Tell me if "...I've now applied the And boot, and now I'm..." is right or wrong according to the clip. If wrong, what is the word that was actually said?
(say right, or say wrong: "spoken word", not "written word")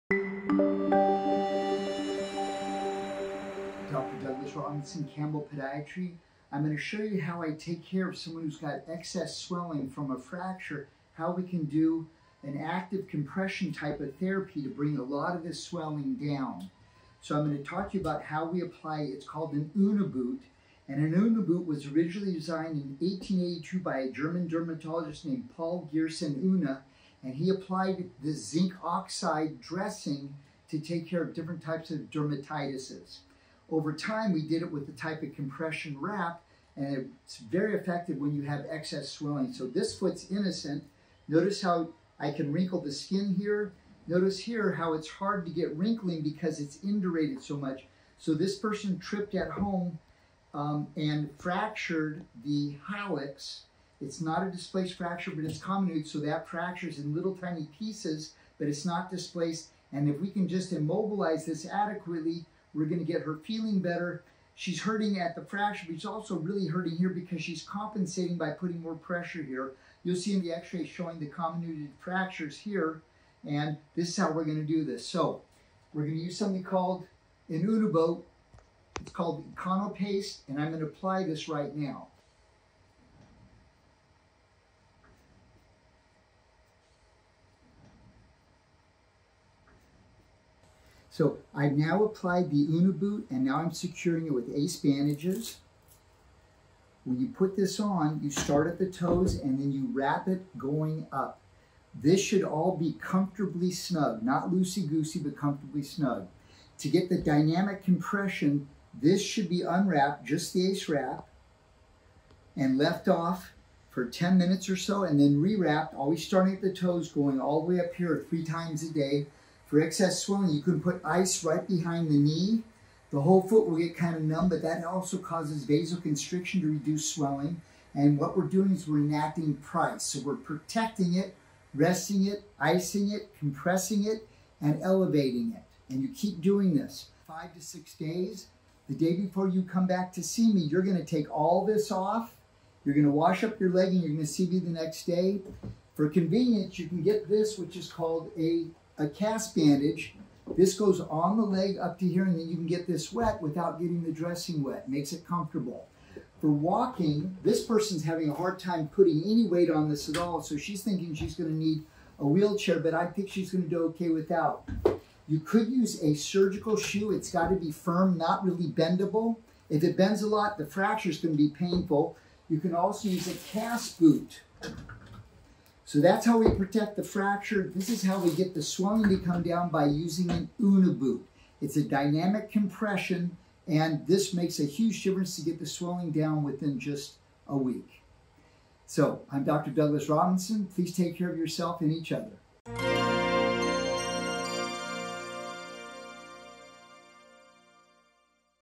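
wrong: "Unna", not "And".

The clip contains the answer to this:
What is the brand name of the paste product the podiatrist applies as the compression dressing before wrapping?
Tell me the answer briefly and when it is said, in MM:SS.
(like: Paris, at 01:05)
Econo Paste, at 01:19.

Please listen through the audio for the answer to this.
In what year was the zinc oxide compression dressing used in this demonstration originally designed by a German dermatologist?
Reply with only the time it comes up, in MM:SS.
00:22.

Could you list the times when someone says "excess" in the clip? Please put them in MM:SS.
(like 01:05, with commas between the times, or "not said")
00:08, 00:38, 01:59.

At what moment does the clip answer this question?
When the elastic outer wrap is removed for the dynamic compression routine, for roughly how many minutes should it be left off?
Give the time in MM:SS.
01:54.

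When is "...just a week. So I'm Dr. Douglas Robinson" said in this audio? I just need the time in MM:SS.
03:06.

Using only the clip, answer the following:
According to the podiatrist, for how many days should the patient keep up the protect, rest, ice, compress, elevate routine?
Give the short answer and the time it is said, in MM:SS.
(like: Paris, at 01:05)
5 to 6 days, at 02:17.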